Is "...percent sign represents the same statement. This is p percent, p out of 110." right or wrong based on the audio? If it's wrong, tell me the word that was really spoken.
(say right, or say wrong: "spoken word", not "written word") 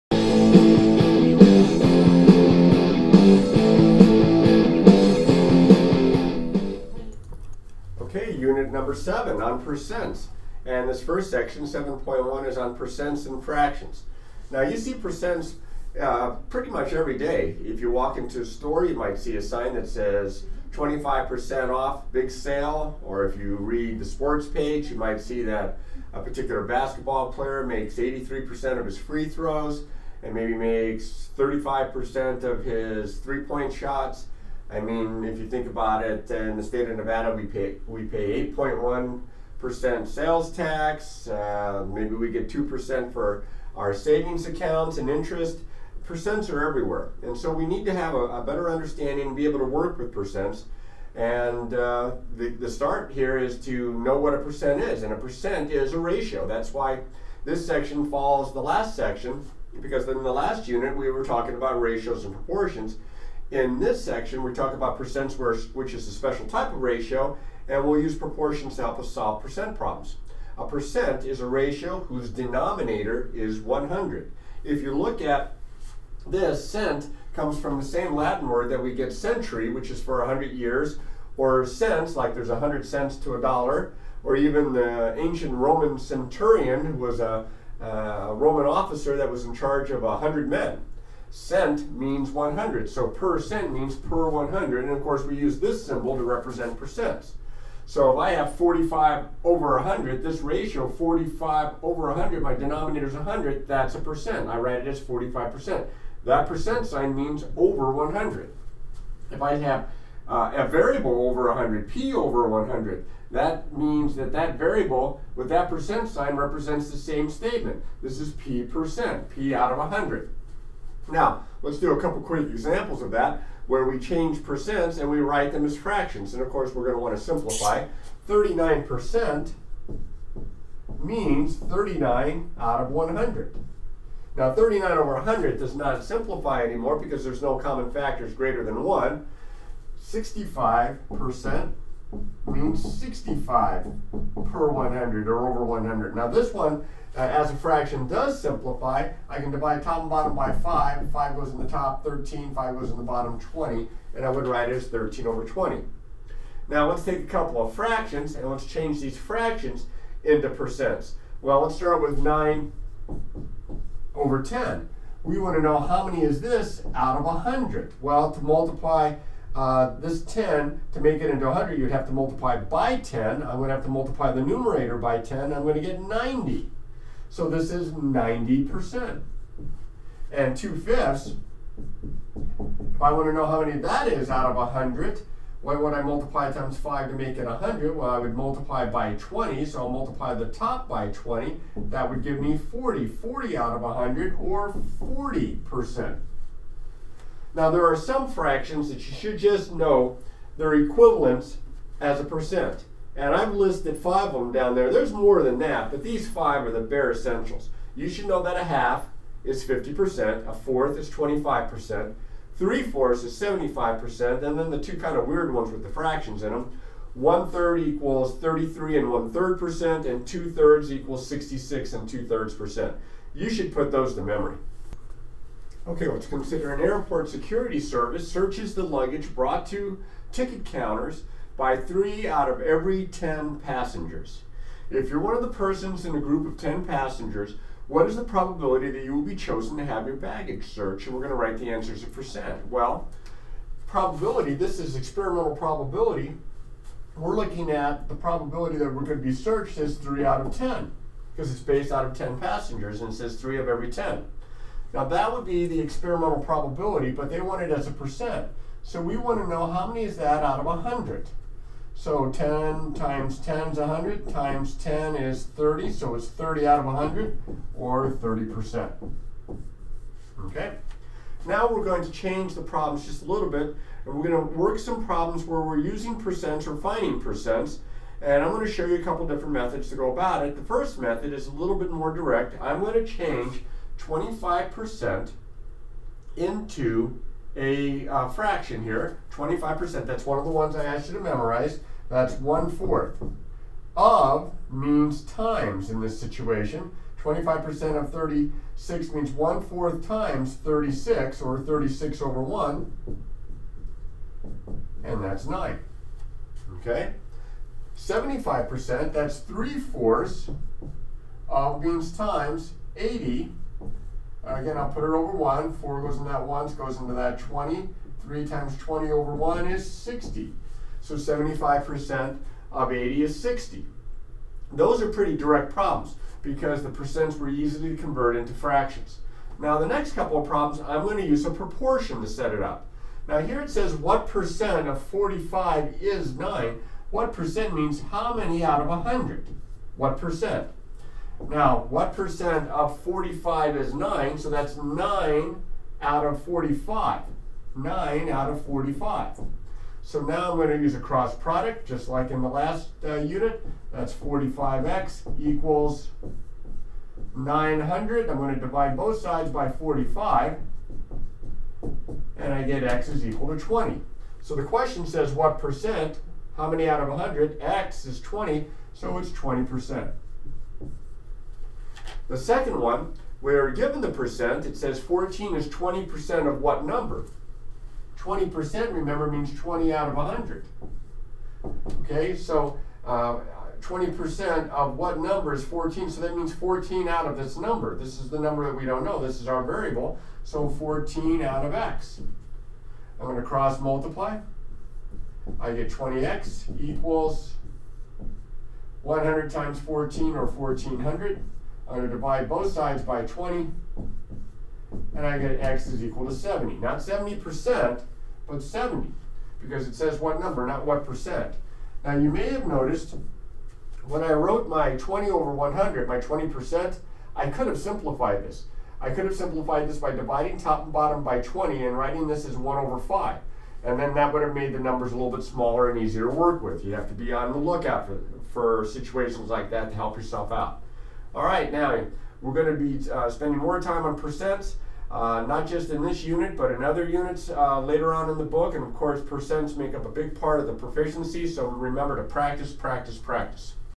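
wrong: "100", not "110".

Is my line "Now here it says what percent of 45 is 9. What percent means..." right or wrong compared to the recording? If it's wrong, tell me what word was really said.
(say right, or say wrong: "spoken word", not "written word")
right.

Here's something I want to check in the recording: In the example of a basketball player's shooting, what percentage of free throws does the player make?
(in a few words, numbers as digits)
83%.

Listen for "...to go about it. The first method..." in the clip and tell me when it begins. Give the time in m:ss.
4:39.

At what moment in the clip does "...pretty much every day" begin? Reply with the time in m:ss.
0:16.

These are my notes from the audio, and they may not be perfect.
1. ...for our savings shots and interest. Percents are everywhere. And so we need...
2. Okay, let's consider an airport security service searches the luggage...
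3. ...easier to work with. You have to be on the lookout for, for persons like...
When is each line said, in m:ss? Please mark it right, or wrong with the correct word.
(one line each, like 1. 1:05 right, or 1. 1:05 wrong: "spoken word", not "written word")
1. 0:43 wrong: "accounts", not "shots"
2. 3:45 right
3. 7:06 wrong: "situations", not "persons".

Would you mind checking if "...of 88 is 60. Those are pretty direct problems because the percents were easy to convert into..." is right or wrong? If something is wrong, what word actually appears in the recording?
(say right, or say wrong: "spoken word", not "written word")
wrong: "80", not "88".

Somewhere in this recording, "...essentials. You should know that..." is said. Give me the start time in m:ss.
3:27.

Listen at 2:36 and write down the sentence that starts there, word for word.
Now let's take a couple of fractions and let's change these fractions into percents.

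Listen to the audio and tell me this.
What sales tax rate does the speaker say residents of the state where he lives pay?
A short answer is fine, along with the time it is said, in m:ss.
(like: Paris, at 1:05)
8.1%, at 0:38.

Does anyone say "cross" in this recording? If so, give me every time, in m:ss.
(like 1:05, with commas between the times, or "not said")
5:50, 6:33.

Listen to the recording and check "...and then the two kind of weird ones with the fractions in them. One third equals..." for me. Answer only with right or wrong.
right.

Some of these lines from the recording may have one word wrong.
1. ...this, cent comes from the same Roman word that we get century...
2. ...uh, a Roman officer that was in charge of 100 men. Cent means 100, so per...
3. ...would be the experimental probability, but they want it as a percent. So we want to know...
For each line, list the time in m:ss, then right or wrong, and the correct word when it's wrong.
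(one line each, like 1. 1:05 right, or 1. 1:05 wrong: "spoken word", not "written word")
1. 1:16 wrong: "Latin", not "Roman"
2. 1:27 right
3. 4:15 right.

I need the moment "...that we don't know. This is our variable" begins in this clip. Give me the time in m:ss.
6:28.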